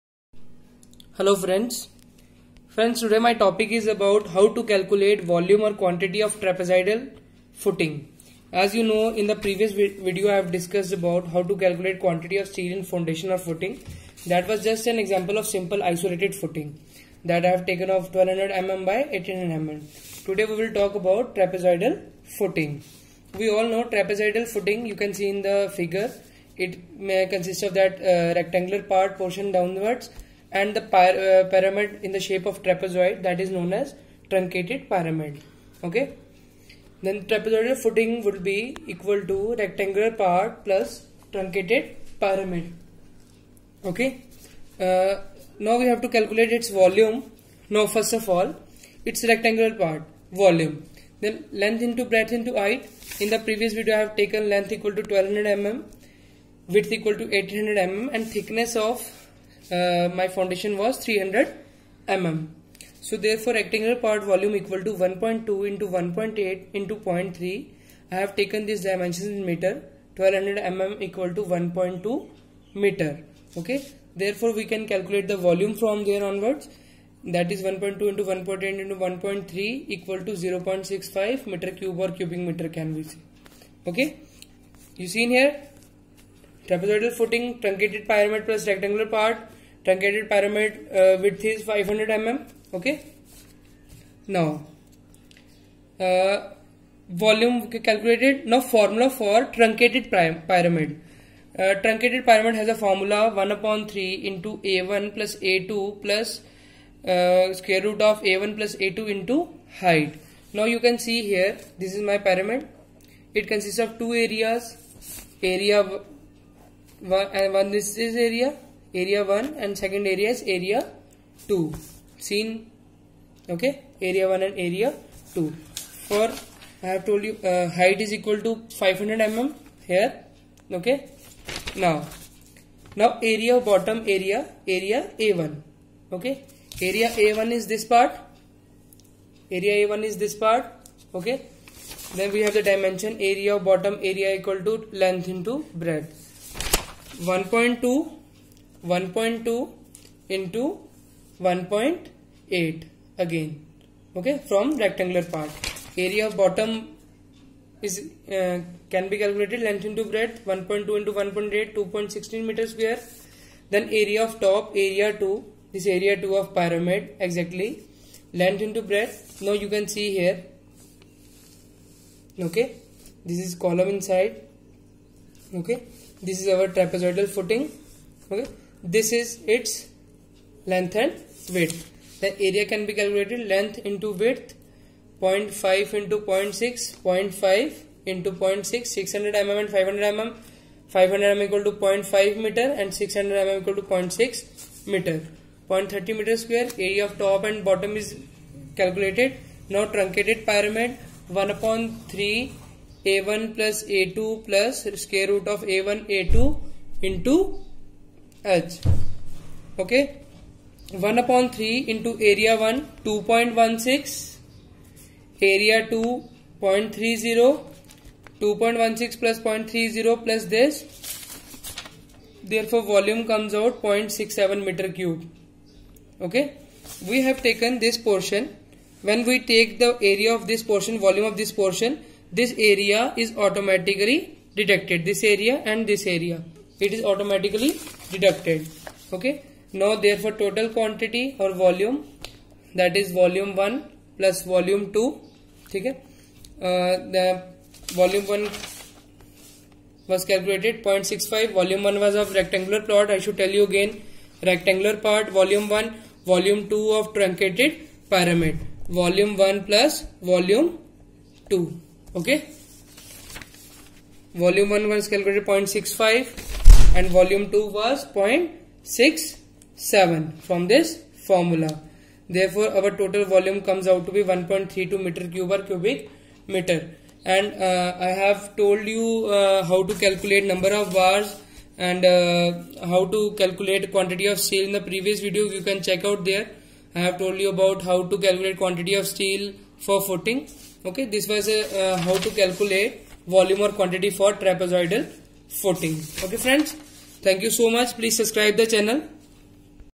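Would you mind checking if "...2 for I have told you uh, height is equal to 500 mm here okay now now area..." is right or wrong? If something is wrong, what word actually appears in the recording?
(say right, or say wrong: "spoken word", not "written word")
right.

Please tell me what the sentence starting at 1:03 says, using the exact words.
So therefore rectangular part volume equal to 1.2 into 1.8 into 0.3.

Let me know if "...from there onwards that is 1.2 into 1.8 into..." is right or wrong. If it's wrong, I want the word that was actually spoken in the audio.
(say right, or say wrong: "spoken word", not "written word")
right.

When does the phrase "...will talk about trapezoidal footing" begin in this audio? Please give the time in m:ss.
0:20.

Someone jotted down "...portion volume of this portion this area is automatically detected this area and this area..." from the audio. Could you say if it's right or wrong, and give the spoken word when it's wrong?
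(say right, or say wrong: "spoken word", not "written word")
right.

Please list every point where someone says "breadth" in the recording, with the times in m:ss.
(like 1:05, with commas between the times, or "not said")
0:52, 2:25, 2:40, 2:48.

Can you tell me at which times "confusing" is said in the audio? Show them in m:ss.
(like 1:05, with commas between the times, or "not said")
not said.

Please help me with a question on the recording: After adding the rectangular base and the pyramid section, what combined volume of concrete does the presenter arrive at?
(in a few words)
1.32 cubic meters.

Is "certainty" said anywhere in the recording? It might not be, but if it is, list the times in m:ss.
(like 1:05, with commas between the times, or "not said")
not said.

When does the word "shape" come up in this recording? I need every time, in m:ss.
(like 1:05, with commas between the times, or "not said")
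0:32.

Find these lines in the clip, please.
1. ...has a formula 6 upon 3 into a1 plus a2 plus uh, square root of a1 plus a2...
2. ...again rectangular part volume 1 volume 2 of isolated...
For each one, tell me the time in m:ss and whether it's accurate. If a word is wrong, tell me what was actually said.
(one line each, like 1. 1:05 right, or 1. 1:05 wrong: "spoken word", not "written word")
1. 1:42 wrong: "1", not "6"
2. 4:13 wrong: "truncated", not "isolated".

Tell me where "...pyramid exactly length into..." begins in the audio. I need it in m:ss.
2:46.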